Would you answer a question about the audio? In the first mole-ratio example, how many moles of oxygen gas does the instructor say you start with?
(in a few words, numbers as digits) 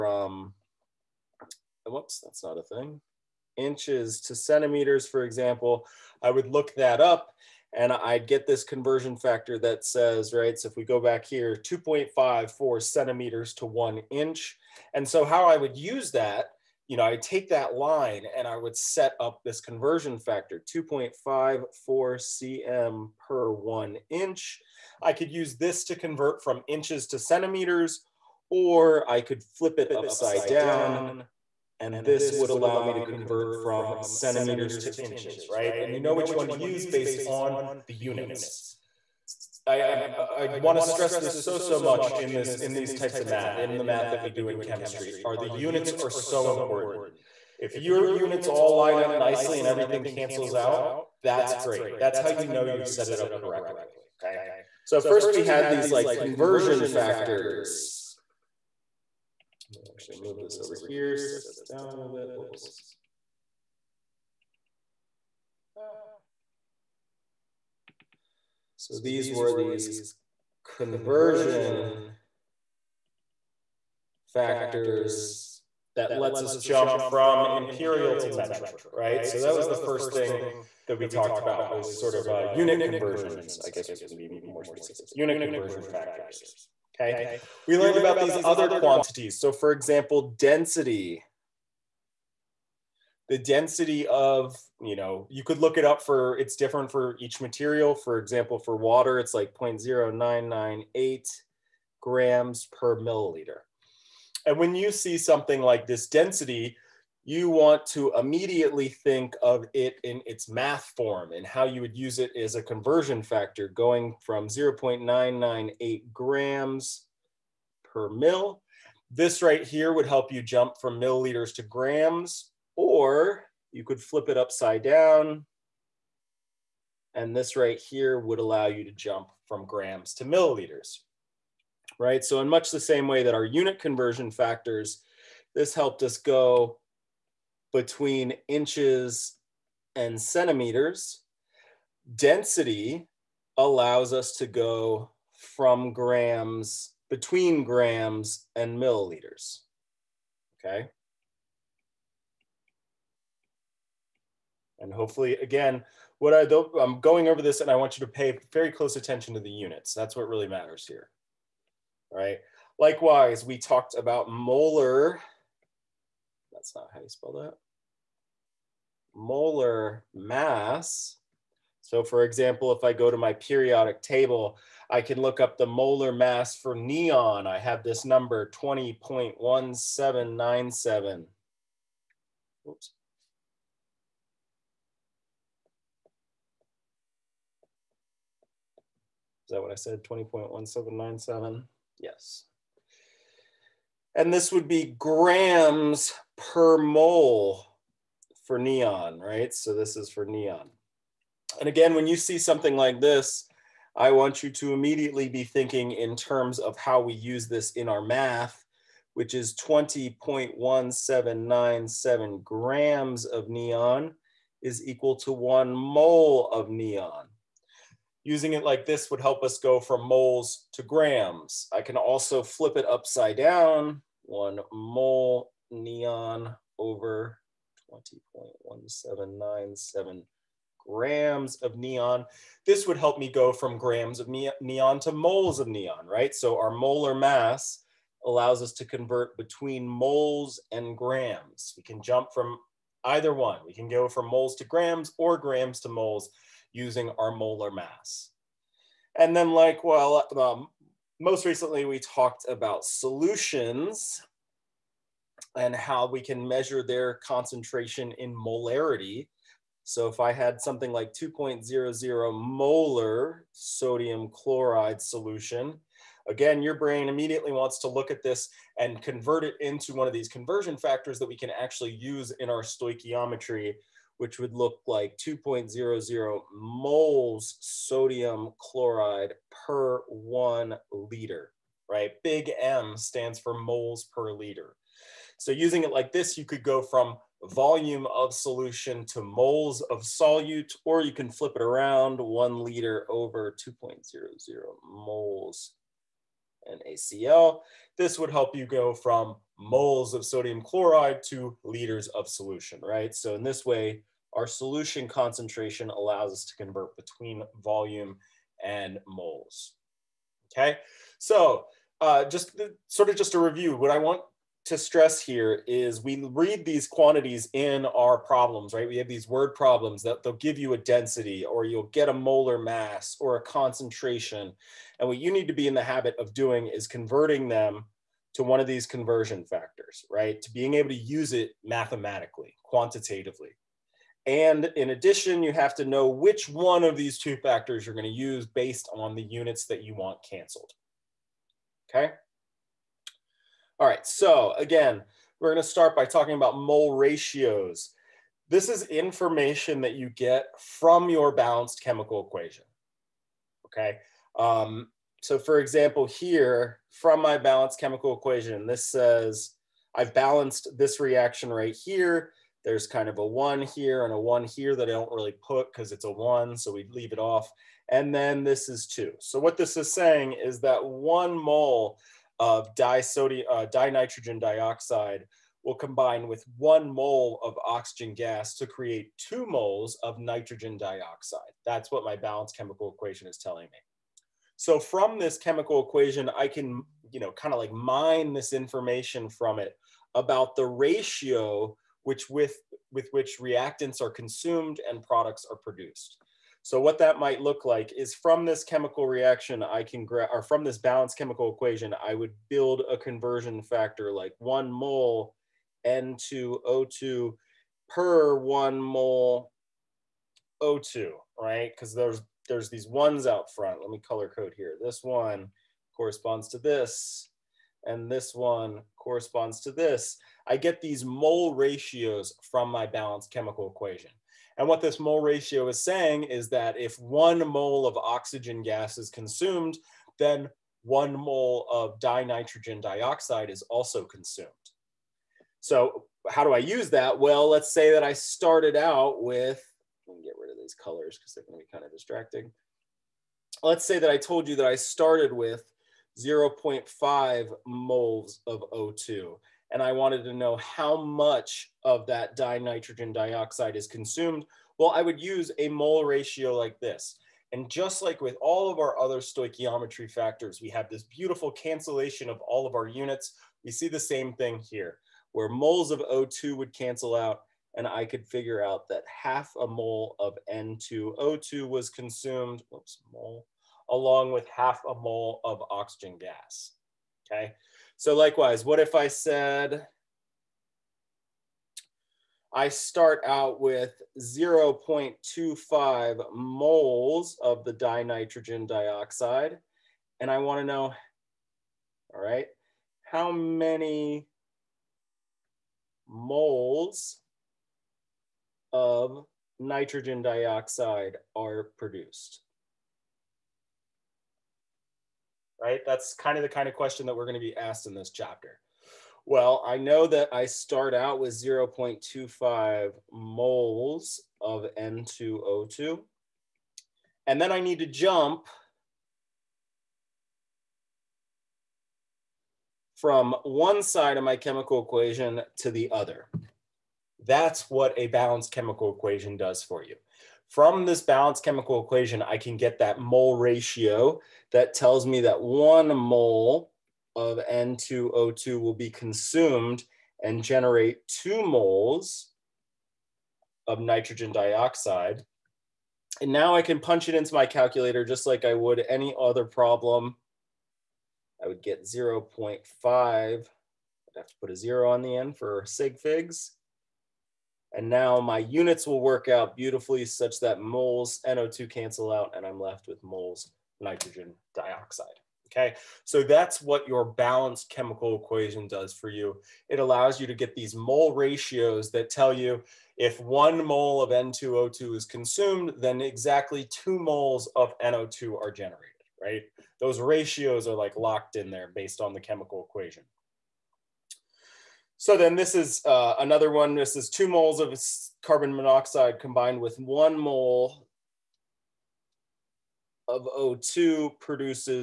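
0.5 moles.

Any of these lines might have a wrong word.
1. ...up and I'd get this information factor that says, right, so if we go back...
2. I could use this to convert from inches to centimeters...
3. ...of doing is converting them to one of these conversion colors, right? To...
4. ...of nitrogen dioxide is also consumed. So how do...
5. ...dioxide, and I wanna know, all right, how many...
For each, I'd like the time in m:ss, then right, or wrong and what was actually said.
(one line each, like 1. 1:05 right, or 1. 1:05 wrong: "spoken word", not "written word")
1. 0:06 wrong: "conversion", not "information"
2. 0:25 right
3. 5:26 wrong: "factors", not "colors"
4. 7:11 wrong: "dinitrogen", not "nitrogen"
5. 8:08 right.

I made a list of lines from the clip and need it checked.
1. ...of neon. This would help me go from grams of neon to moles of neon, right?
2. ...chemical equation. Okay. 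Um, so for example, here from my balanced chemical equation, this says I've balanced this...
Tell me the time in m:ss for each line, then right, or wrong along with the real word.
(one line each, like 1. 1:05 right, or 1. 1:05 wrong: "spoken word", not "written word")
1. 3:51 right
2. 5:51 right.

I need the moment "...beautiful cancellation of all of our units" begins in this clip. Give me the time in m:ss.
7:41.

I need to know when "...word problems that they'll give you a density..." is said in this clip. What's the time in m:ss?
5:19.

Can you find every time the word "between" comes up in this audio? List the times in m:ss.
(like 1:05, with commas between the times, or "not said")
2:17, 2:27, 3:59, 5:06.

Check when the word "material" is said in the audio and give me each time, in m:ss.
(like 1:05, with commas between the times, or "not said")
1:37.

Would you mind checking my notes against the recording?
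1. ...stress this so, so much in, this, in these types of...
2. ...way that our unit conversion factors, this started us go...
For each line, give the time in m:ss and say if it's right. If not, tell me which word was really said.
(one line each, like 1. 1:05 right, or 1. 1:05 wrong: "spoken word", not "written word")
1. 0:40 right
2. 2:13 wrong: "helped", not "started".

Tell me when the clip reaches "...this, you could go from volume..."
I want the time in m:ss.
4:46.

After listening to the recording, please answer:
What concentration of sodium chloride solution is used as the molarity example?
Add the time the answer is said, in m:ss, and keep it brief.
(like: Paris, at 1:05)
2.00 molar, at 4:21.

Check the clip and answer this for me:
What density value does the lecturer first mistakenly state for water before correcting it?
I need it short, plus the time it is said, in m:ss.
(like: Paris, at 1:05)
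0.0998 grams per milliliter, at 1:39.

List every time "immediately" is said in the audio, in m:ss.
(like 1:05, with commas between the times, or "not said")
1:48, 3:24, 4:27.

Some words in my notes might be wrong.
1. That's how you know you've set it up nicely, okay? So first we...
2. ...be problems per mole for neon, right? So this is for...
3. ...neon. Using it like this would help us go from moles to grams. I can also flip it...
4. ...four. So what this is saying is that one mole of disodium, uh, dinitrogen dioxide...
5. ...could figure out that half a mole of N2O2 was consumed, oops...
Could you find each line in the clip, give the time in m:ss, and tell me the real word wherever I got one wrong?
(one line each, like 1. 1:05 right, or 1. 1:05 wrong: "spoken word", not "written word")
1. 0:51 wrong: "correctly", not "nicely"
2. 3:14 wrong: "grams", not "problems"
3. 3:36 right
4. 6:08 wrong: "two", not "four"
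5. 7:48 right.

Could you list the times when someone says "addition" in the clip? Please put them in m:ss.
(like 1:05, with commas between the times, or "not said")
5:34.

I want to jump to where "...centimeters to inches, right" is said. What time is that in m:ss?
0:33.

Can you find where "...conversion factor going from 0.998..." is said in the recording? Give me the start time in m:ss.
1:52.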